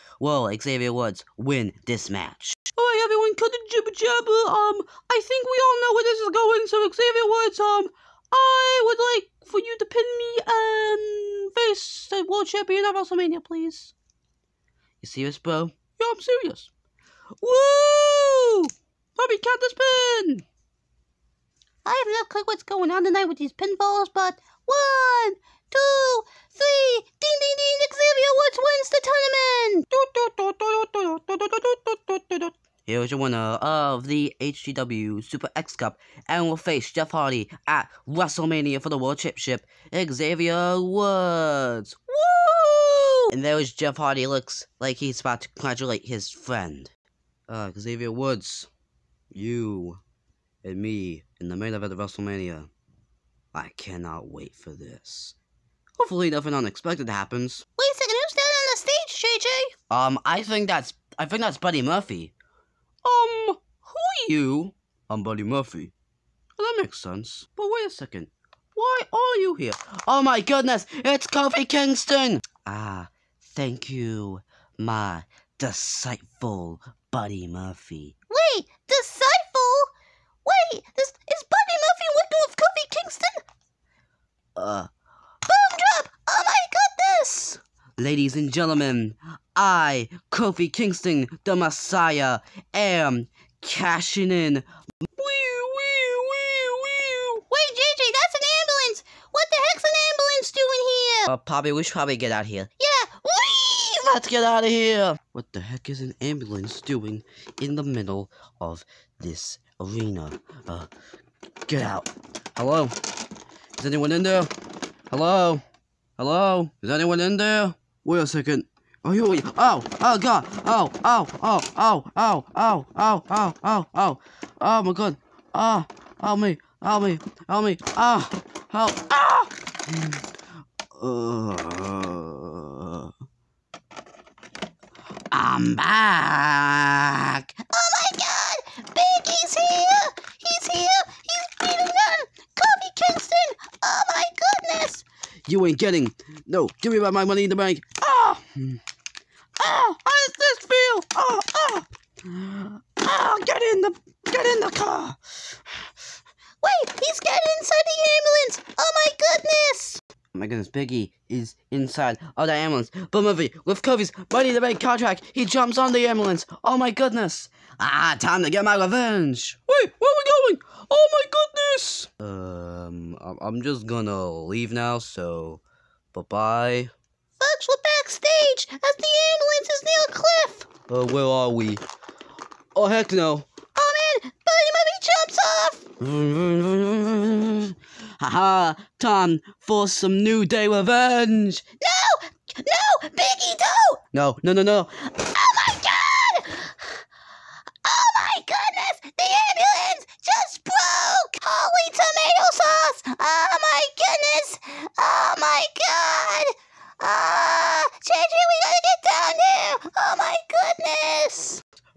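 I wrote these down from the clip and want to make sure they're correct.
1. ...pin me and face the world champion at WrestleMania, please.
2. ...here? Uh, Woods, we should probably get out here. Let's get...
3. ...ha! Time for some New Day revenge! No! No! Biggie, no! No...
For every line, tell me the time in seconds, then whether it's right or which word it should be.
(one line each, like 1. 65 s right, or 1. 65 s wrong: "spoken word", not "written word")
1. 9 s right
2. 101 s wrong: "Poppy", not "Woods"
3. 188 s right.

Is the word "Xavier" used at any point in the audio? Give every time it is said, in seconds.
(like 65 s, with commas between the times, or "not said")
0 s, 6 s, 27 s, 40 s, 47 s.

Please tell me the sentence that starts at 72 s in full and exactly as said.
Ah, Thank you, my deceitful Buddy Murphy.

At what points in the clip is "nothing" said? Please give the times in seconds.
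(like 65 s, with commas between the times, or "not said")
56 s.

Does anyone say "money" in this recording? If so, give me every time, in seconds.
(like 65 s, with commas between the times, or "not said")
147 s, 164 s.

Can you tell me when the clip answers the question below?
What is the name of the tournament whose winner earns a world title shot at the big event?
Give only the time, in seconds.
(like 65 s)
34 s.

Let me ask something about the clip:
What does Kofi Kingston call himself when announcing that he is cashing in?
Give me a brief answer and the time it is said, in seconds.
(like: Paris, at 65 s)
The Messiah, at 91 s.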